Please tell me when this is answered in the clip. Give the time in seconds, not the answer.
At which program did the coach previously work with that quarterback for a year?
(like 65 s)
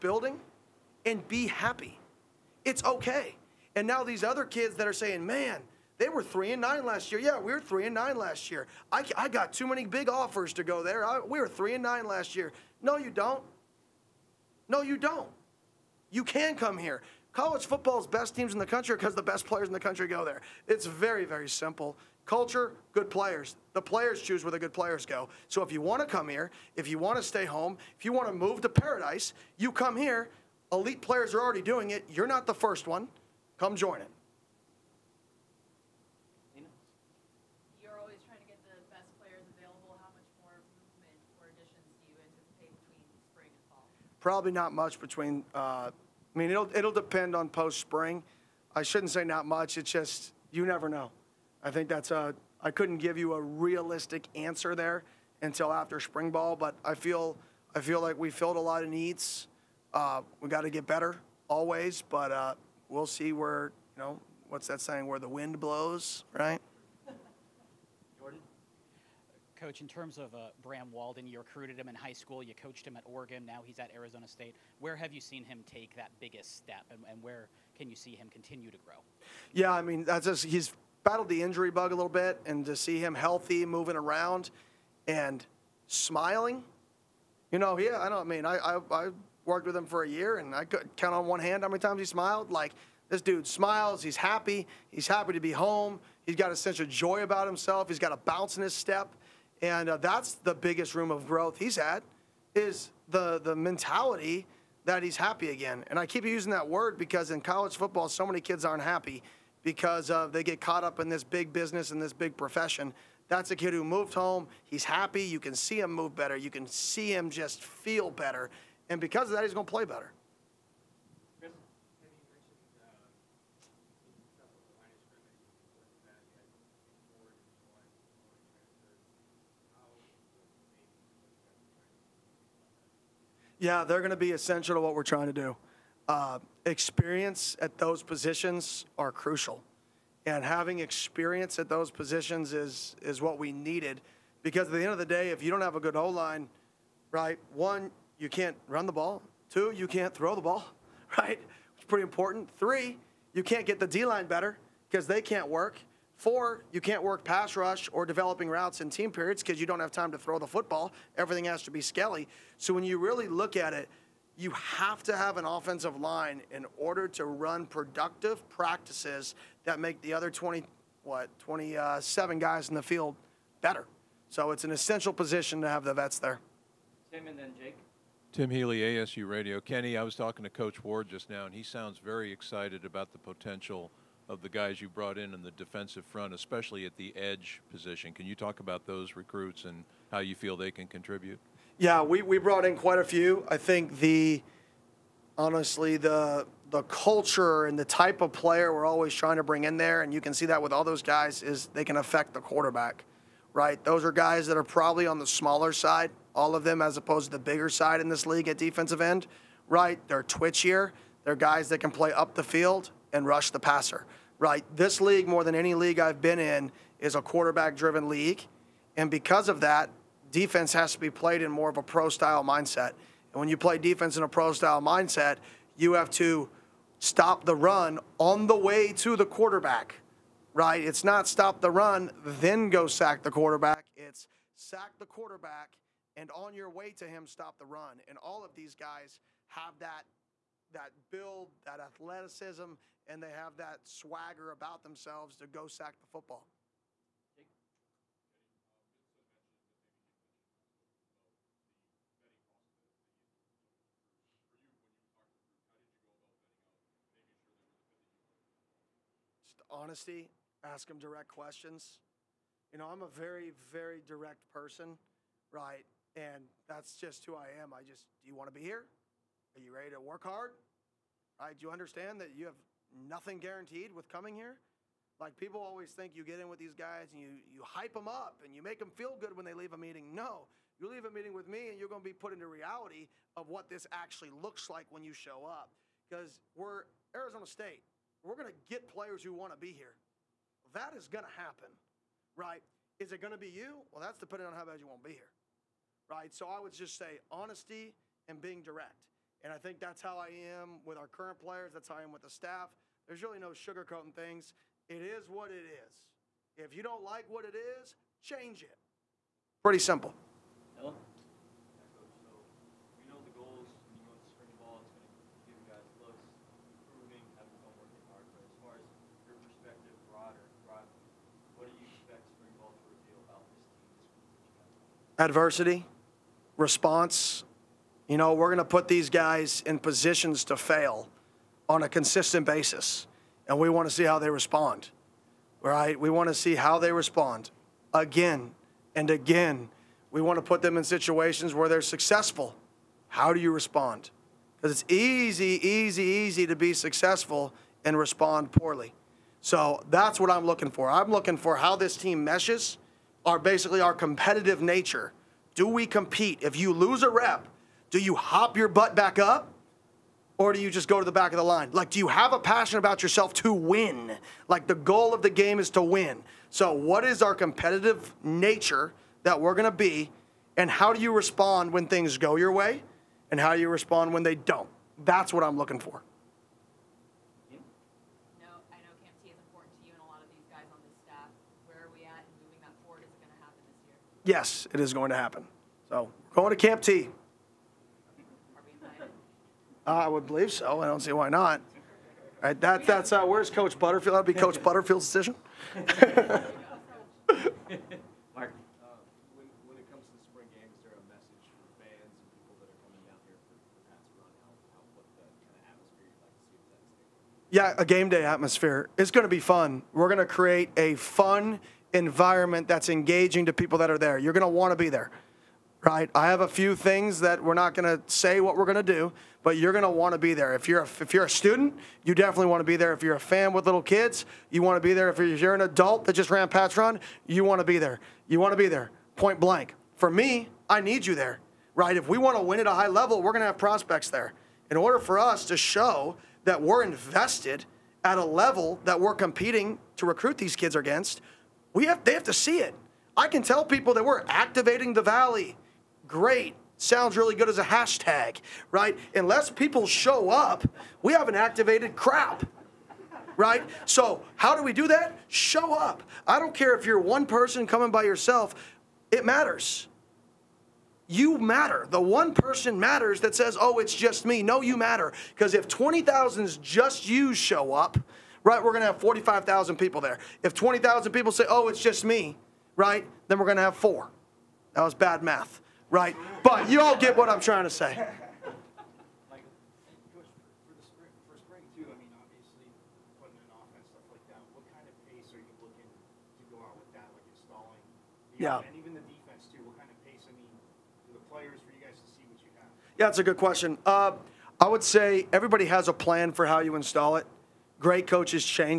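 73 s.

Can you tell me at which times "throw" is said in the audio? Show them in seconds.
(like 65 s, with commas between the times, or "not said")
150 s, 160 s.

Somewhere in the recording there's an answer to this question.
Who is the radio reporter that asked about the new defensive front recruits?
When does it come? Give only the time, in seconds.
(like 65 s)
178 s.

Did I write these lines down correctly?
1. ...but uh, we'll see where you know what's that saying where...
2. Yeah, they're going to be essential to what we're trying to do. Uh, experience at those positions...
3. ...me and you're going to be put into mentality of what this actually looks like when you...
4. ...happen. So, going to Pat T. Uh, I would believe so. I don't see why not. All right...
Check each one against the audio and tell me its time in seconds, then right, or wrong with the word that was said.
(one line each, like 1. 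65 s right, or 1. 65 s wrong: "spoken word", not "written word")
1. 62 s right
2. 133 s right
3. 281 s wrong: "reality", not "mentality"
4. 385 s wrong: "Camp", not "Pat".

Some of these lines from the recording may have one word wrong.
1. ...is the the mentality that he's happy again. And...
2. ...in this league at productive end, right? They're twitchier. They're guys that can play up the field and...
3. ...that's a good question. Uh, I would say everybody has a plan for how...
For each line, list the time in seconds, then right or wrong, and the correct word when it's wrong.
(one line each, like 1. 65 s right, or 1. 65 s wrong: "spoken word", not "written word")
1. 102 s right
2. 208 s wrong: "defensive", not "productive"
3. 493 s right.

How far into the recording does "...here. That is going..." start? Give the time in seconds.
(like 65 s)
289 s.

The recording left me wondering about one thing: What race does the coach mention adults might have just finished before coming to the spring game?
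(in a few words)
Pat's run.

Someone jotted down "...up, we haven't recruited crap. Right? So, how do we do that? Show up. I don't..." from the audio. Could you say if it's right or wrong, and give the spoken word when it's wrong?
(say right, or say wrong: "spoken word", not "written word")
wrong: "activated", not "recruited".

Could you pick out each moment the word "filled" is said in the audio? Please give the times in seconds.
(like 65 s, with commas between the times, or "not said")
58 s.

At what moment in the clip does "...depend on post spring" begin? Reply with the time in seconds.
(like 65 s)
46 s.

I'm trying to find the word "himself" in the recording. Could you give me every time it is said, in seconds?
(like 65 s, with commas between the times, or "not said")
97 s.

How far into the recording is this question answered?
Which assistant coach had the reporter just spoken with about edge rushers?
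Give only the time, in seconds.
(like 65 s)
180 s.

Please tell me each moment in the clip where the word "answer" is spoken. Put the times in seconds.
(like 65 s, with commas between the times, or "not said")
54 s.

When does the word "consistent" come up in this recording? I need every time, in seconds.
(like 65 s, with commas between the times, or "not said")
331 s.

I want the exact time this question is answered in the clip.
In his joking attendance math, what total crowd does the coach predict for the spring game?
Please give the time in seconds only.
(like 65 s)
468 s.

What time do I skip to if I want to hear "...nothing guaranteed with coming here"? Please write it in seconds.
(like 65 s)
272 s.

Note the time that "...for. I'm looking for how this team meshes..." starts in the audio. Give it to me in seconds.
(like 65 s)
350 s.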